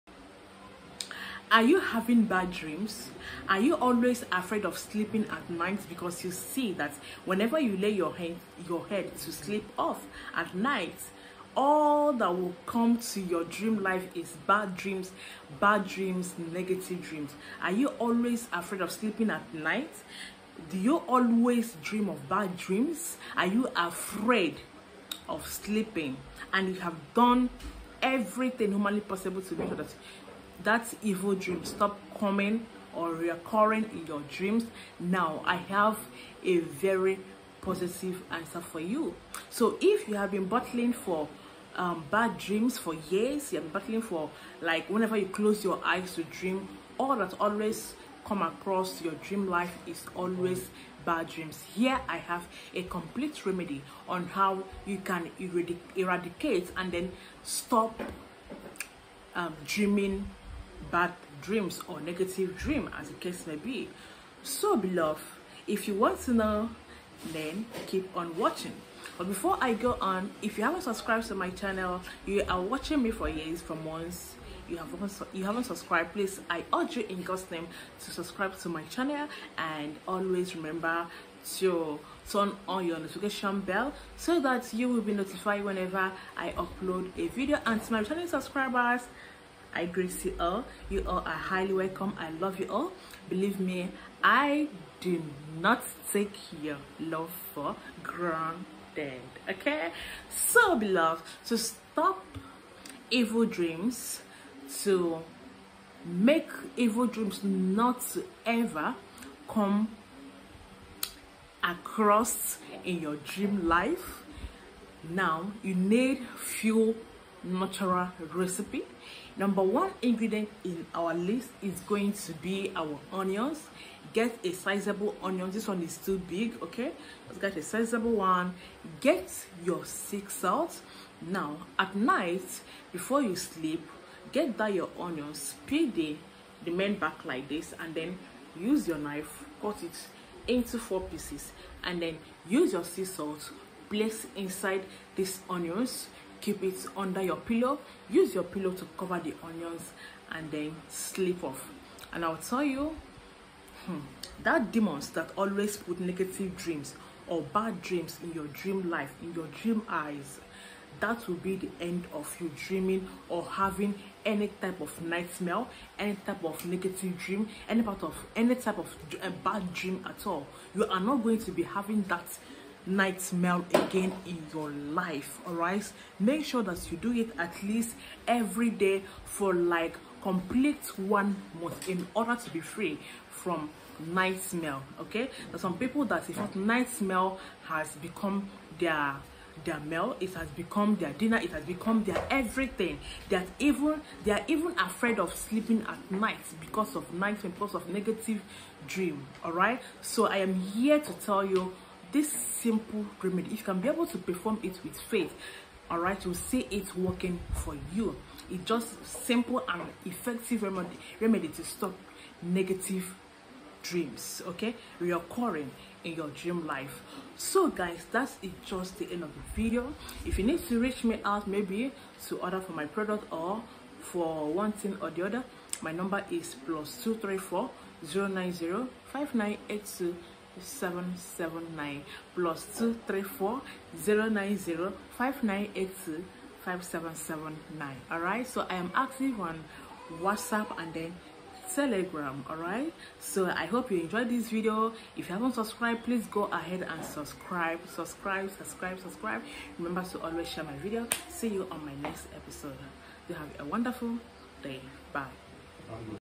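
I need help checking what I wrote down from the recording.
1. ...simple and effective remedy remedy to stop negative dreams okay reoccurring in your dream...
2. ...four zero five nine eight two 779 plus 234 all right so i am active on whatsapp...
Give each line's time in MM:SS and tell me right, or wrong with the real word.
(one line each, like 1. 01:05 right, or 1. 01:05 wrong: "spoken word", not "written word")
1. 03:29 right
2. 03:48 wrong: "nine", not "four".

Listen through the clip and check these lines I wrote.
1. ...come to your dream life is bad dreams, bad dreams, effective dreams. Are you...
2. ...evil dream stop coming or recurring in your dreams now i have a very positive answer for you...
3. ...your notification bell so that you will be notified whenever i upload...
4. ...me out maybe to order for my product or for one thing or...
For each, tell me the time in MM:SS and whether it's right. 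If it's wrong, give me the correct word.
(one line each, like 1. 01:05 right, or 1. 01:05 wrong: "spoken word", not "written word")
1. 00:12 wrong: "negative", not "effective"
2. 00:31 right
3. 01:22 right
4. 03:41 right.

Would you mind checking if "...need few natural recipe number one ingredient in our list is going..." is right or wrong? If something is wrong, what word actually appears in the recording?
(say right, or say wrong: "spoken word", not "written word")
right.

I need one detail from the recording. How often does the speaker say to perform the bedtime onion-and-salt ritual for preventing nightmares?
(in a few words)
every day.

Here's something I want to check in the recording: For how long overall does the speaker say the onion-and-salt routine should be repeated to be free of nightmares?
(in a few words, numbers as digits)
1 month.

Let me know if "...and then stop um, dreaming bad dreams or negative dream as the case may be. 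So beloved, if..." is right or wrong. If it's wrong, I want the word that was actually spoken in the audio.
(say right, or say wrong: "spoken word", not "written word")
right.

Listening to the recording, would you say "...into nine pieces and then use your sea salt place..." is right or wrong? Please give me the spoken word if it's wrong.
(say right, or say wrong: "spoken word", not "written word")
wrong: "four", not "nine".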